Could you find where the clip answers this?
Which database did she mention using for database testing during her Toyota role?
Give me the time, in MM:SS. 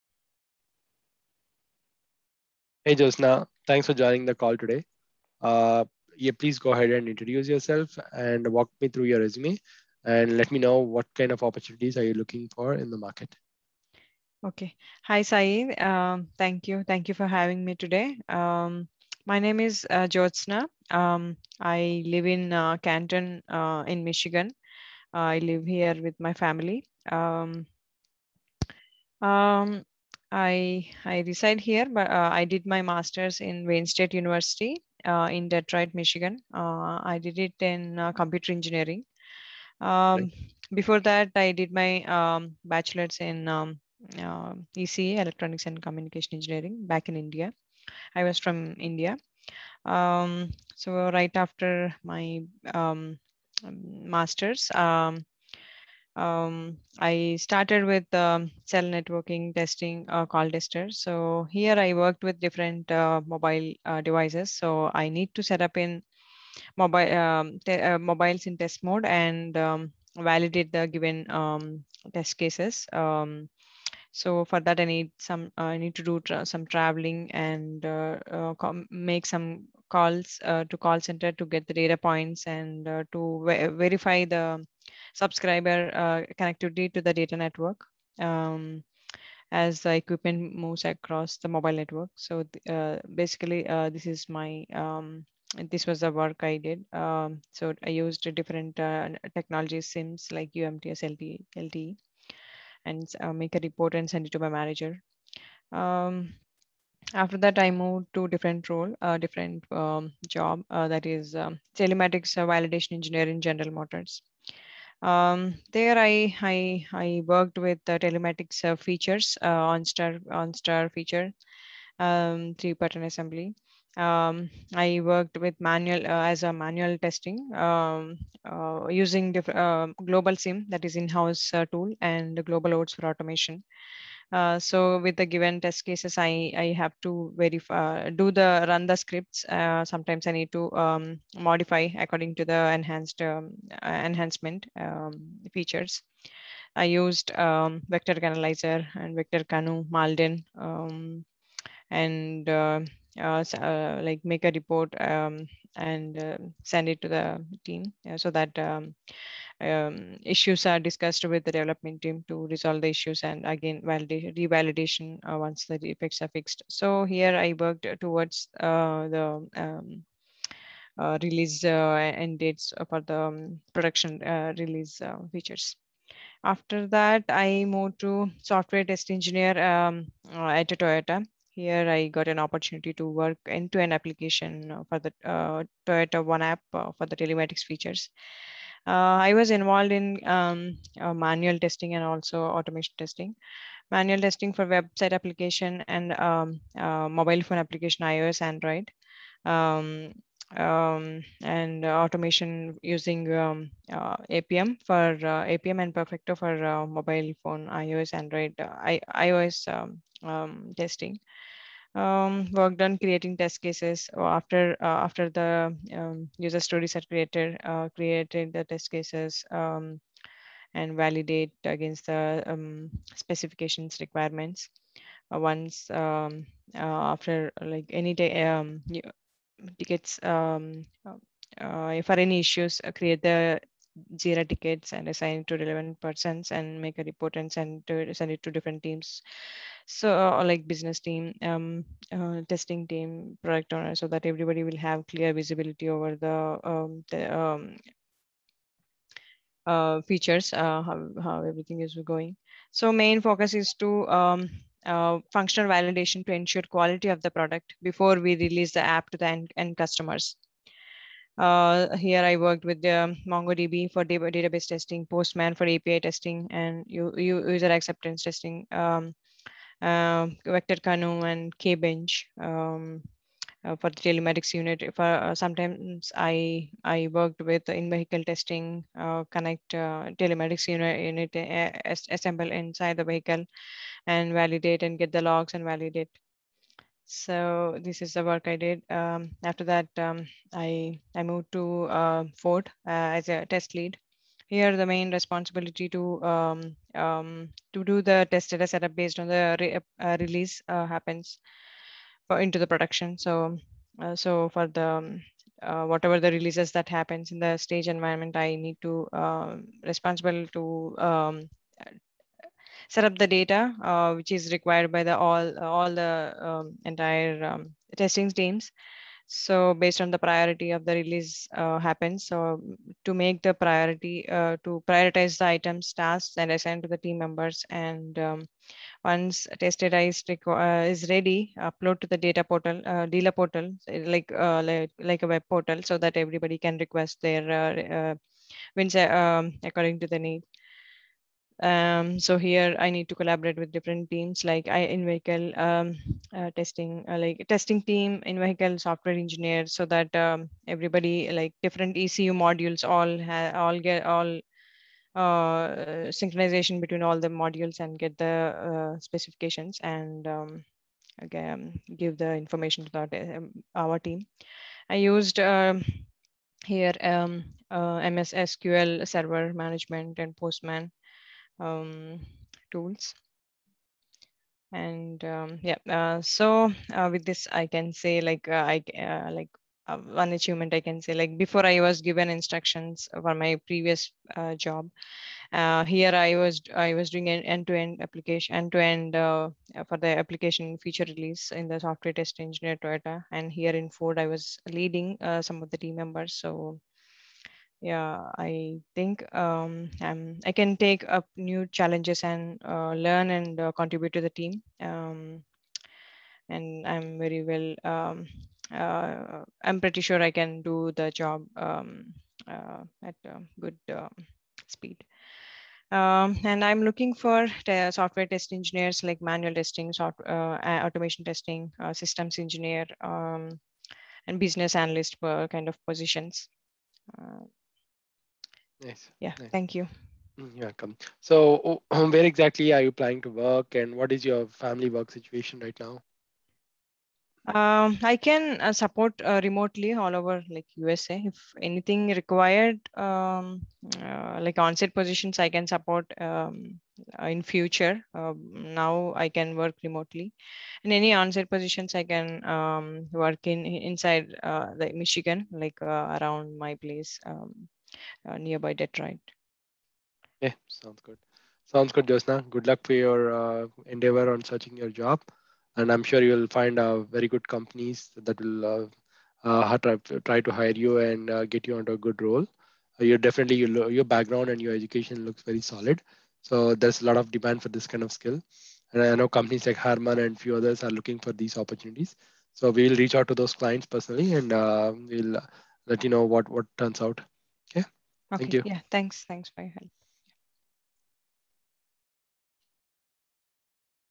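04:23.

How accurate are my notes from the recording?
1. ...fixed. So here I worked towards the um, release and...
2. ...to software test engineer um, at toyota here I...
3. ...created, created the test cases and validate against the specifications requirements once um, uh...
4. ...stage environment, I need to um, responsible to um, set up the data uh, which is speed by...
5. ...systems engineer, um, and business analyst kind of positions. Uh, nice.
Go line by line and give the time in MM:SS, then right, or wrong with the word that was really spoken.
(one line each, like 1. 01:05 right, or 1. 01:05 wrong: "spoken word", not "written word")
1. 02:46 right
2. 02:57 right
3. 03:37 right
4. 05:07 wrong: "required", not "speed"
5. 07:01 right.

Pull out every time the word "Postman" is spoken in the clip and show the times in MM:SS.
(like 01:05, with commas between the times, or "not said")
04:25, 06:10.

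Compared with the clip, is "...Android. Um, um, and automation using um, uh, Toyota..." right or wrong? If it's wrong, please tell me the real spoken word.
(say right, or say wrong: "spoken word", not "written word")
wrong: "Appium", not "Toyota".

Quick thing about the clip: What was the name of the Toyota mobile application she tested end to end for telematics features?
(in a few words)
Toyota One app.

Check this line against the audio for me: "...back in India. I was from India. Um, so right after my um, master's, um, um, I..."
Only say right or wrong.
right.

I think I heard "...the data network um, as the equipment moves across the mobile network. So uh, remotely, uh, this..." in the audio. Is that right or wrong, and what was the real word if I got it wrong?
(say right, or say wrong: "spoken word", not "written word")
wrong: "basically", not "remotely".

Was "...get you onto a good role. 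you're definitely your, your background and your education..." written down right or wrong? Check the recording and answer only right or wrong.
right.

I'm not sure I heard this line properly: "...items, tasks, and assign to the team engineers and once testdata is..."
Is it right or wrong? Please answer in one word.
wrong.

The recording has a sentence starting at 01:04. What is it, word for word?
So I need to set up in mobile um, uh, mobiles in test mode and um, validate the given um, test cases.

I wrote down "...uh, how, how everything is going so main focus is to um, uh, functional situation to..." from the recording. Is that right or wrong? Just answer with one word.
wrong.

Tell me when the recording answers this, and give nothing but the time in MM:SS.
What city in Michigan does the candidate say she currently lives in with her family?
00:22.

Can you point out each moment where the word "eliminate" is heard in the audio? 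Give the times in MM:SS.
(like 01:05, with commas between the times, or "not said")
not said.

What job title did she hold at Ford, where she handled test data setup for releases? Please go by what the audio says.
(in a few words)
test lead.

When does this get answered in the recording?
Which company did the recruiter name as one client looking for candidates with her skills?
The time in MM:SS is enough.
07:59.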